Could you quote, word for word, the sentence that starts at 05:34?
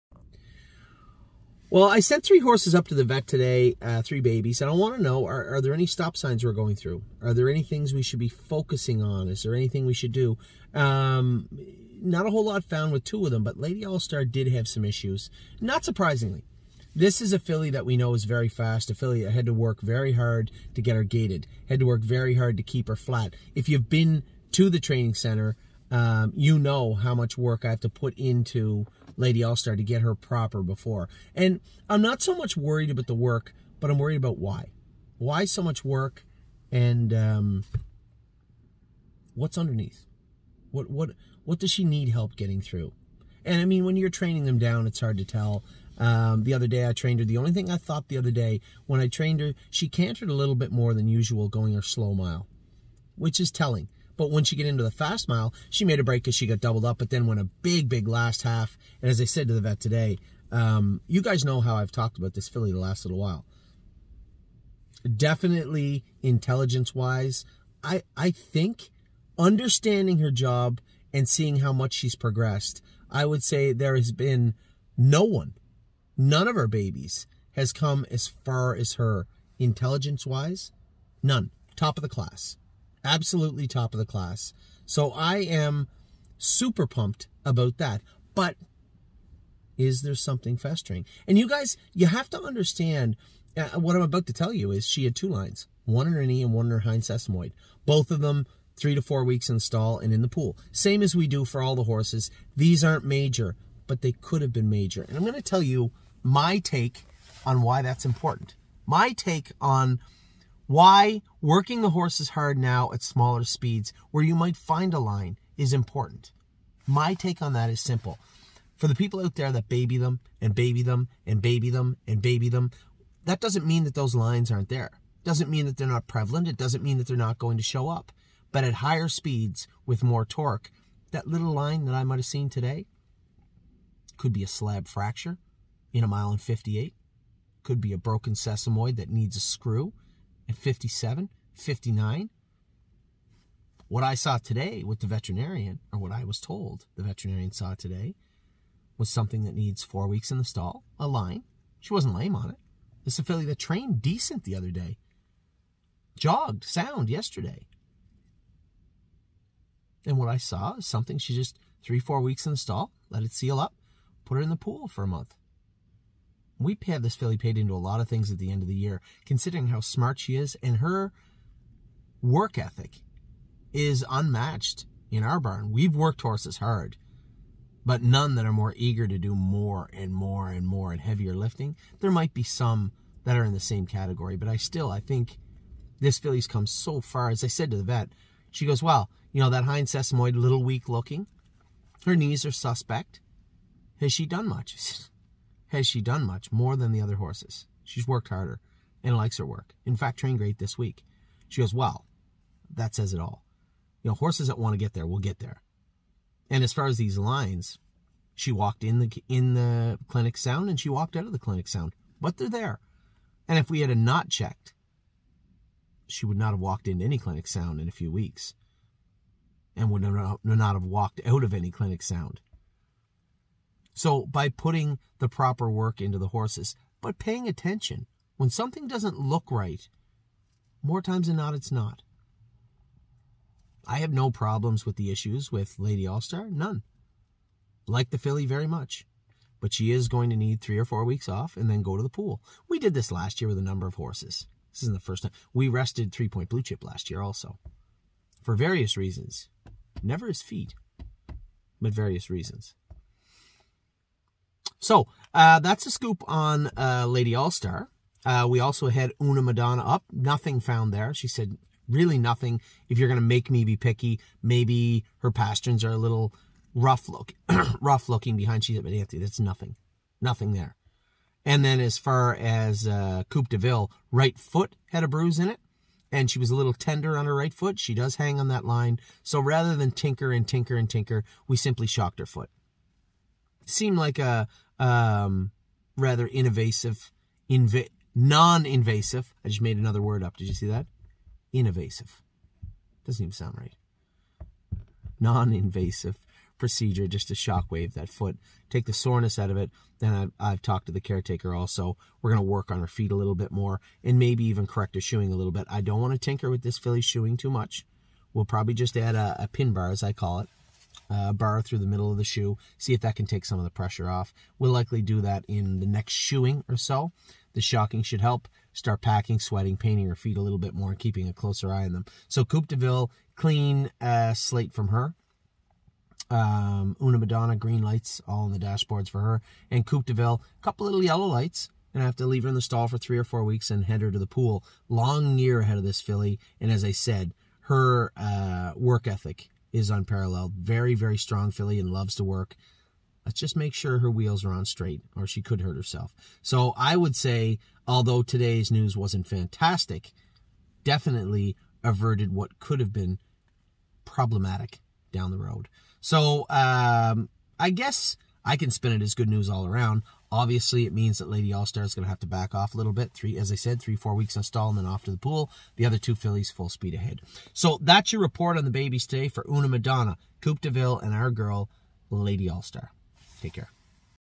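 Long year ahead of this filly, and as I said, her uh, work ethic is unparalleled.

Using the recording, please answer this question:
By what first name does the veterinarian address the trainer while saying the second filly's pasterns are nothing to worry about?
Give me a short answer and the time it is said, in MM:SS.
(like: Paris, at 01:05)
Anthony, at 04:28.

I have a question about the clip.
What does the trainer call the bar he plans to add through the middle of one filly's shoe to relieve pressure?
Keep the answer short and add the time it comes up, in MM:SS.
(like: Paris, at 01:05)
pin bar, at 05:09.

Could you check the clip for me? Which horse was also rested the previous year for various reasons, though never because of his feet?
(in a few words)
Three Point Blue Chip.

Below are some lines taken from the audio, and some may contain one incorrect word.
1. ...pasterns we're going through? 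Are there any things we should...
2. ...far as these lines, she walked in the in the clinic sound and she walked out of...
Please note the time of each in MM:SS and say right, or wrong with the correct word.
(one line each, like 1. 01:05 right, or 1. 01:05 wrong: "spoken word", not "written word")
1. 00:06 wrong: "signs", not "pasterns"
2. 03:26 right.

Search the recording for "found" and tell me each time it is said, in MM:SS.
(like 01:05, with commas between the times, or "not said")
00:12, 04:20.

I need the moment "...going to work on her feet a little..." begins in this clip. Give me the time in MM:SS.
05:02.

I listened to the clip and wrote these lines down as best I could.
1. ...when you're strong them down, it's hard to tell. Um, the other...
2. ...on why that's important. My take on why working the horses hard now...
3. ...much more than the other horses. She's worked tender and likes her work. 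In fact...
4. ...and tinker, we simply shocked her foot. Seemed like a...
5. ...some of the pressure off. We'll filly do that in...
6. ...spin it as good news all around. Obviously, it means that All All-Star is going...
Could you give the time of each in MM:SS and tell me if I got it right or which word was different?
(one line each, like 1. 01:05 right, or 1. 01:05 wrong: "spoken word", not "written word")
1. 00:43 wrong: "training", not "strong"
2. 01:47 right
3. 03:16 wrong: "harder", not "tender"
4. 04:40 right
5. 05:13 wrong: "likely", not "filly"
6. 05:58 wrong: "Lady", not "All".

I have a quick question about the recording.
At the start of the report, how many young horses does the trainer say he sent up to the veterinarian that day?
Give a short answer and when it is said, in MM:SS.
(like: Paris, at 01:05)
3, at 00:02.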